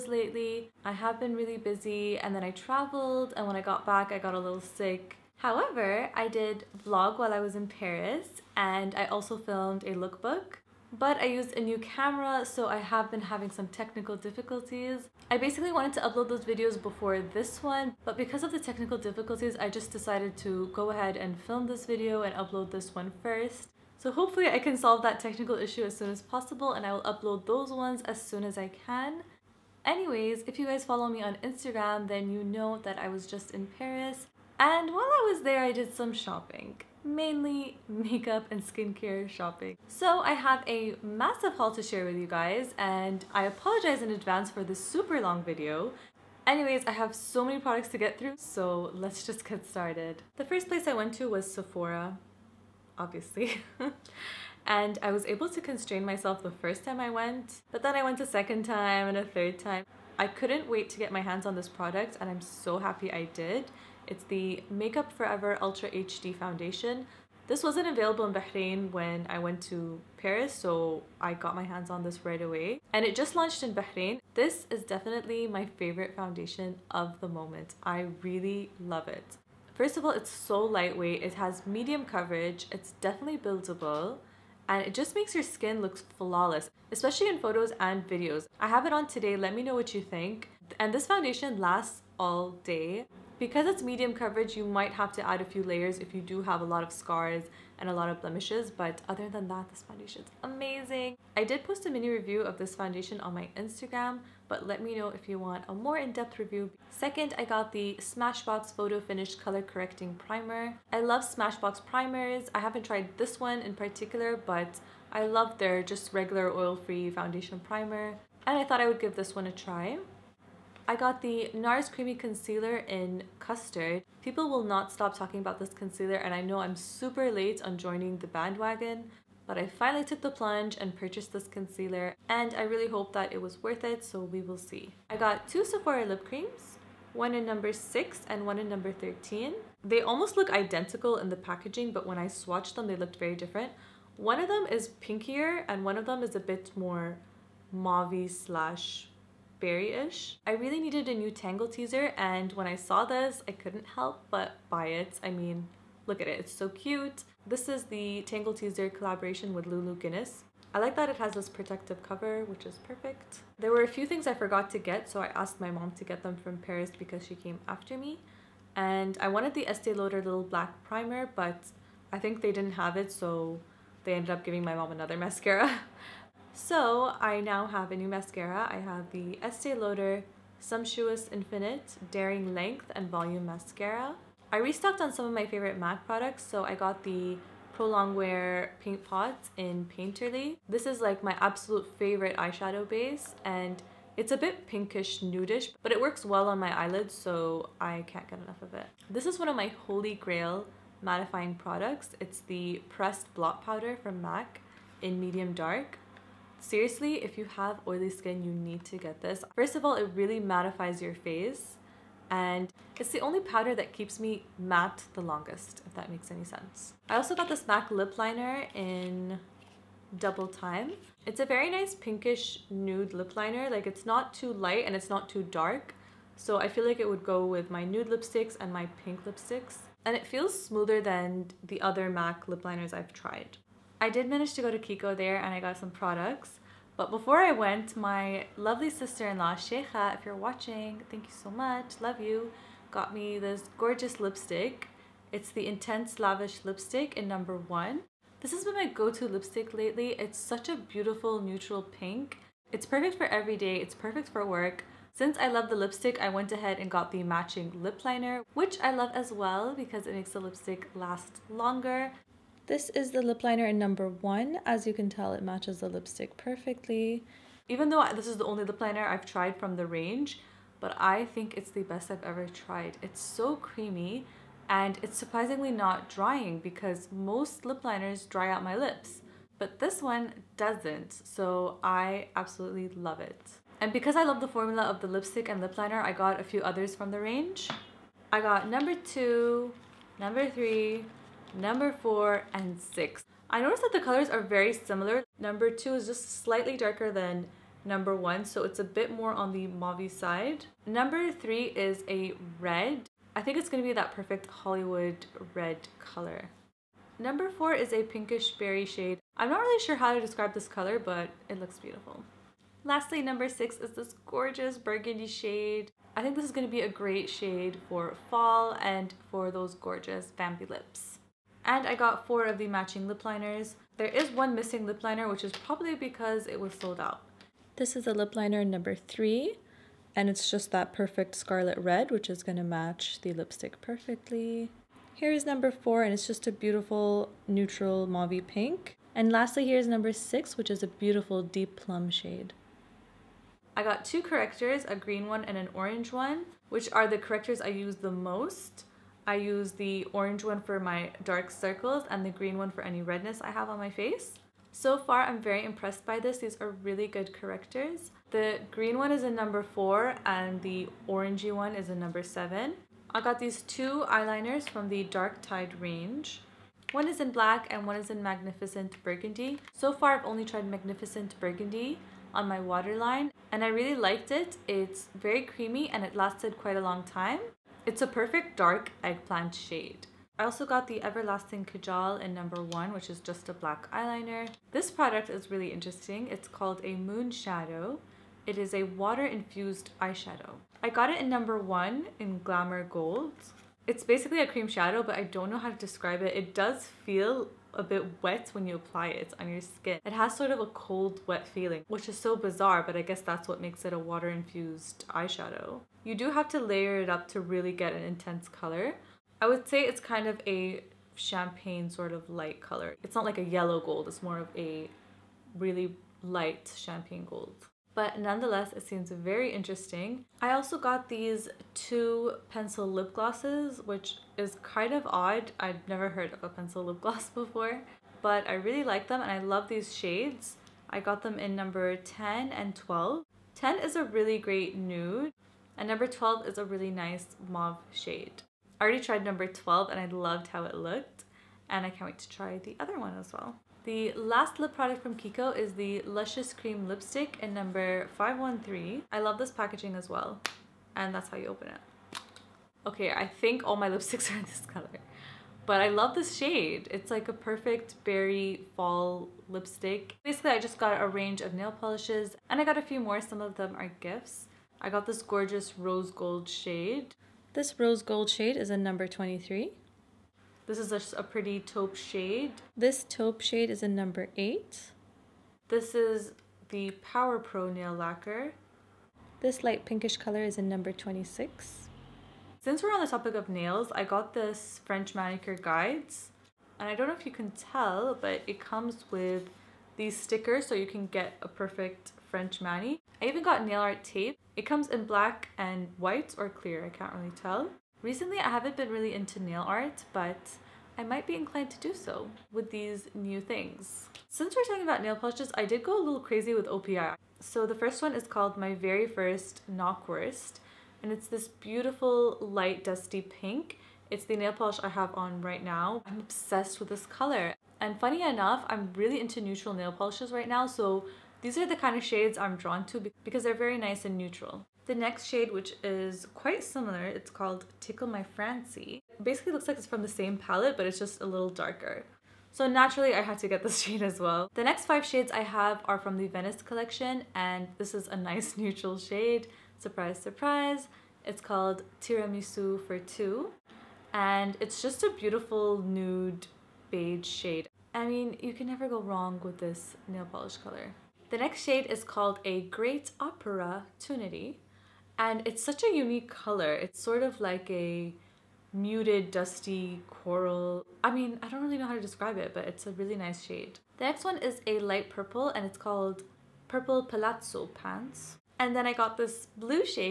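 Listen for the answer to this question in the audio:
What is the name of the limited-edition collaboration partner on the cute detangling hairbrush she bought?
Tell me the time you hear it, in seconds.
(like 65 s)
159 s.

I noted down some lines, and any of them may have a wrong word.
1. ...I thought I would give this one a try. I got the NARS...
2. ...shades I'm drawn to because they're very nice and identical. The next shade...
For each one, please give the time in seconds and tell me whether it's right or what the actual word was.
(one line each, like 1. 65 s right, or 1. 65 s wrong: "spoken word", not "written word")
1. 118 s right
2. 522 s wrong: "neutral", not "identical".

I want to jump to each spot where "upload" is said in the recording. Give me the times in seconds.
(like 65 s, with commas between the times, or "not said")
16 s, 22 s, 27 s.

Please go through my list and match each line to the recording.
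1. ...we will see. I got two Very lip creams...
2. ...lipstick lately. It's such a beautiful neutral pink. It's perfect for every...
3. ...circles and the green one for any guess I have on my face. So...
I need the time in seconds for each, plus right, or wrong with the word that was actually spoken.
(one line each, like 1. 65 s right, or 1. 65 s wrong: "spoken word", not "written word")
1. 134 s wrong: "Sephora", not "Very"
2. 249 s right
3. 351 s wrong: "redness", not "guess".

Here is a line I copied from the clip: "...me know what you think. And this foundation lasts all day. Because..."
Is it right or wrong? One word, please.
right.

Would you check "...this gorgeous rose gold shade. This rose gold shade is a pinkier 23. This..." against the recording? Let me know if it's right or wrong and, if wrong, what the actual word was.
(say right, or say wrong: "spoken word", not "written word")
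wrong: "number", not "pinkier".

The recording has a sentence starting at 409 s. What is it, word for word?
I would say it's kind of a champagne sort of light color.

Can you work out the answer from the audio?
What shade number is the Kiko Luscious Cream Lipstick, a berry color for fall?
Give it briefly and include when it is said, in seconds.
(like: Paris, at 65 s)
513, at 448 s.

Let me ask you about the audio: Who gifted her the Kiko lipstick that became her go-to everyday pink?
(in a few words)
Sheikha.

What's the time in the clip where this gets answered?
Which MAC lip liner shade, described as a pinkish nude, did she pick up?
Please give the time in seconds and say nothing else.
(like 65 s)
220 s.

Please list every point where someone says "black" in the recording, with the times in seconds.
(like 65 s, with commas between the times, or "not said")
170 s, 367 s, 383 s, 495 s.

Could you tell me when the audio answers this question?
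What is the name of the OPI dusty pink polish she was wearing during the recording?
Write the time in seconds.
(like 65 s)
508 s.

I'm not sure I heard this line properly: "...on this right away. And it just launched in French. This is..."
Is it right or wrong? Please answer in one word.
wrong.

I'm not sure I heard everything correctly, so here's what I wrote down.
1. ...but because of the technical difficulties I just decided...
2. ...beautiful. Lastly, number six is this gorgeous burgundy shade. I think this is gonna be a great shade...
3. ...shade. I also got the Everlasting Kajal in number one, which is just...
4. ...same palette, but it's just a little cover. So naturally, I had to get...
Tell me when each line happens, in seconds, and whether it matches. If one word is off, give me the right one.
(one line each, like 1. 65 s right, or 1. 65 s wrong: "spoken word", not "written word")
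1. 18 s right
2. 311 s right
3. 379 s right
4. 530 s wrong: "darker", not "cover".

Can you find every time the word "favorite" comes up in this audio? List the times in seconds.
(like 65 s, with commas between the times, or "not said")
75 s, 185 s, 191 s.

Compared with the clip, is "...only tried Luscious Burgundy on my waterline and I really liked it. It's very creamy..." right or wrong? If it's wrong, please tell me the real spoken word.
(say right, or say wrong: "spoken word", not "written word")
wrong: "Magnificent", not "Luscious".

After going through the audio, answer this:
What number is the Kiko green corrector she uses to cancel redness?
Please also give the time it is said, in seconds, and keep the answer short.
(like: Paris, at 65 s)
4, at 359 s.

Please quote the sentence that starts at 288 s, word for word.
I got number two, number three, number four, and six.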